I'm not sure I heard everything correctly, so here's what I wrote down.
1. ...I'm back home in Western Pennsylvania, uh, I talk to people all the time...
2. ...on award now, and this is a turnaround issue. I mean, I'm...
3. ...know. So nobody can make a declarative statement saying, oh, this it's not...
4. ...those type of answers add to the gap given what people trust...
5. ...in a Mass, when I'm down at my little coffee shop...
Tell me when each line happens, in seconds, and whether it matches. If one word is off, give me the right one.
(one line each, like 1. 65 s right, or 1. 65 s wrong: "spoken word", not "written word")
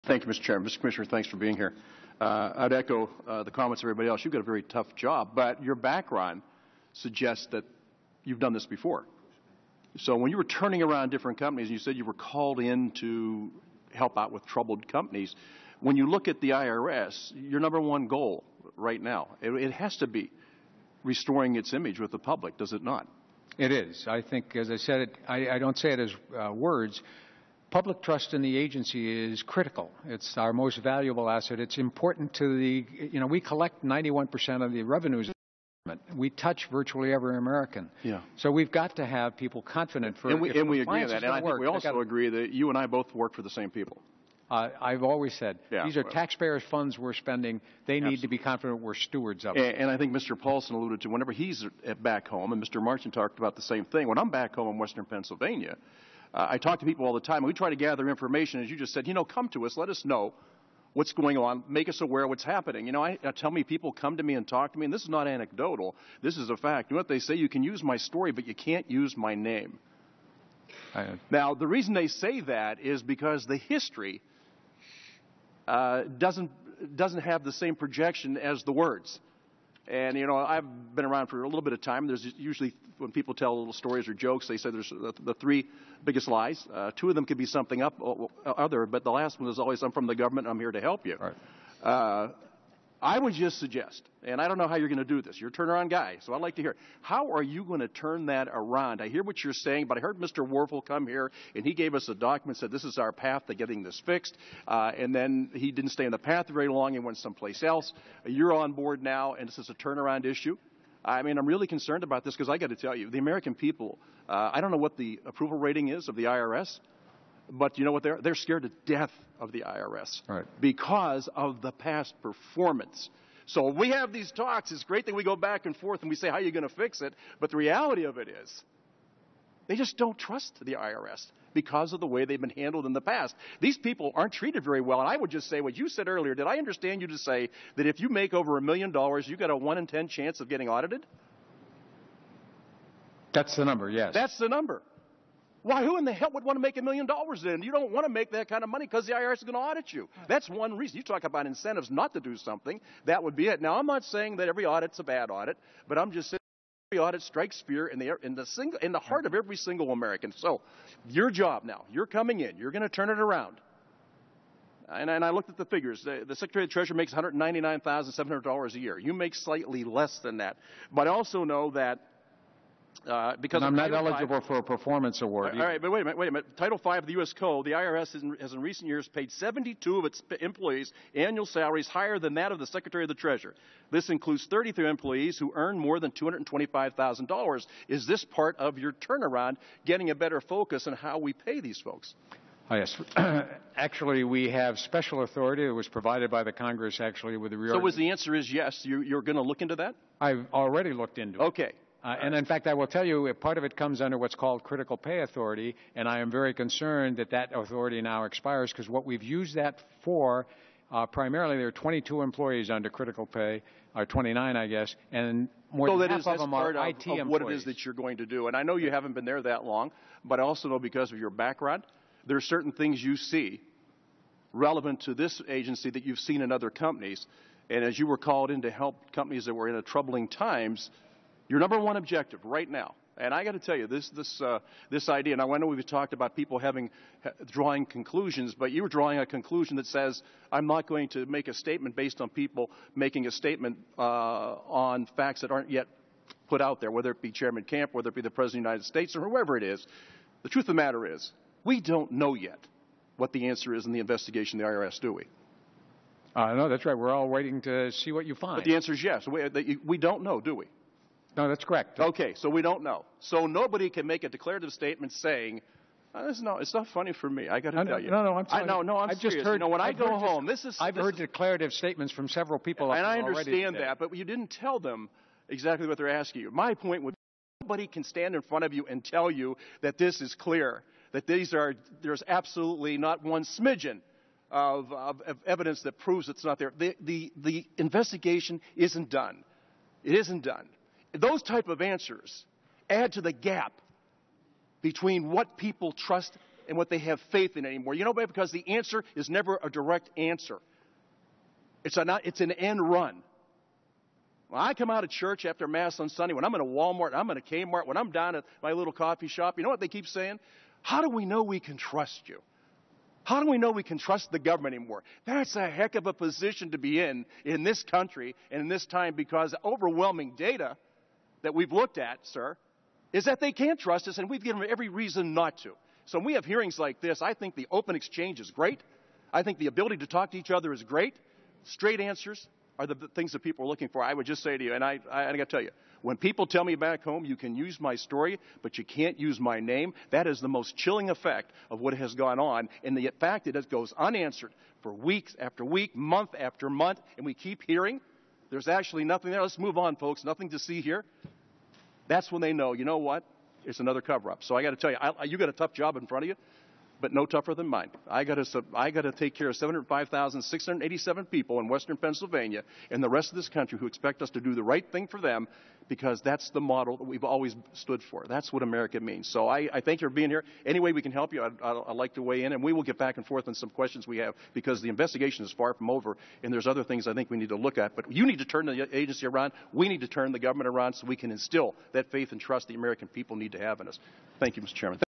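1. 54 s right
2. 108 s wrong: "board", not "award"
3. 262 s right
4. 291 s wrong: "between", not "given"
5. 307 s wrong: "Kmart", not "Mass".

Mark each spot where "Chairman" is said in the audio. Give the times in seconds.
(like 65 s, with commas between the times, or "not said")
0 s, 247 s, 384 s.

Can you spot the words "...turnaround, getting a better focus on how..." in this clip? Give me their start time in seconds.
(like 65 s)
188 s.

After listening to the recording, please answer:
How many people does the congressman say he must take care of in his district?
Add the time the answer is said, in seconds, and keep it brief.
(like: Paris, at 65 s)
705,687, at 359 s.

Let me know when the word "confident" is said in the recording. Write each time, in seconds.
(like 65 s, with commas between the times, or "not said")
39 s, 48 s.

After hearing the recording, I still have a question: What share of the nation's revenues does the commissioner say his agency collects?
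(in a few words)
91%.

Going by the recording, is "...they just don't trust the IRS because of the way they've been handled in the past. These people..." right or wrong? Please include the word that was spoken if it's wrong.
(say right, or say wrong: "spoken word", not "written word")
right.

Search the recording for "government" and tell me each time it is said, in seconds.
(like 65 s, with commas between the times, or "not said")
90 s, 314 s, 380 s.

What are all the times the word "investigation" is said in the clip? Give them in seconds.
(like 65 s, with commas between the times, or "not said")
253 s, 287 s, 374 s.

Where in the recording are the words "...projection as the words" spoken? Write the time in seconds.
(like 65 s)
77 s.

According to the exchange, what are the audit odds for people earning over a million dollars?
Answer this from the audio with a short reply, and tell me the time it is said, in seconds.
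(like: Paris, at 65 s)
one in ten, at 139 s.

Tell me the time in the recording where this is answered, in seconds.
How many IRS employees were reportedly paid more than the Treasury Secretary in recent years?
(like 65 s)
179 s.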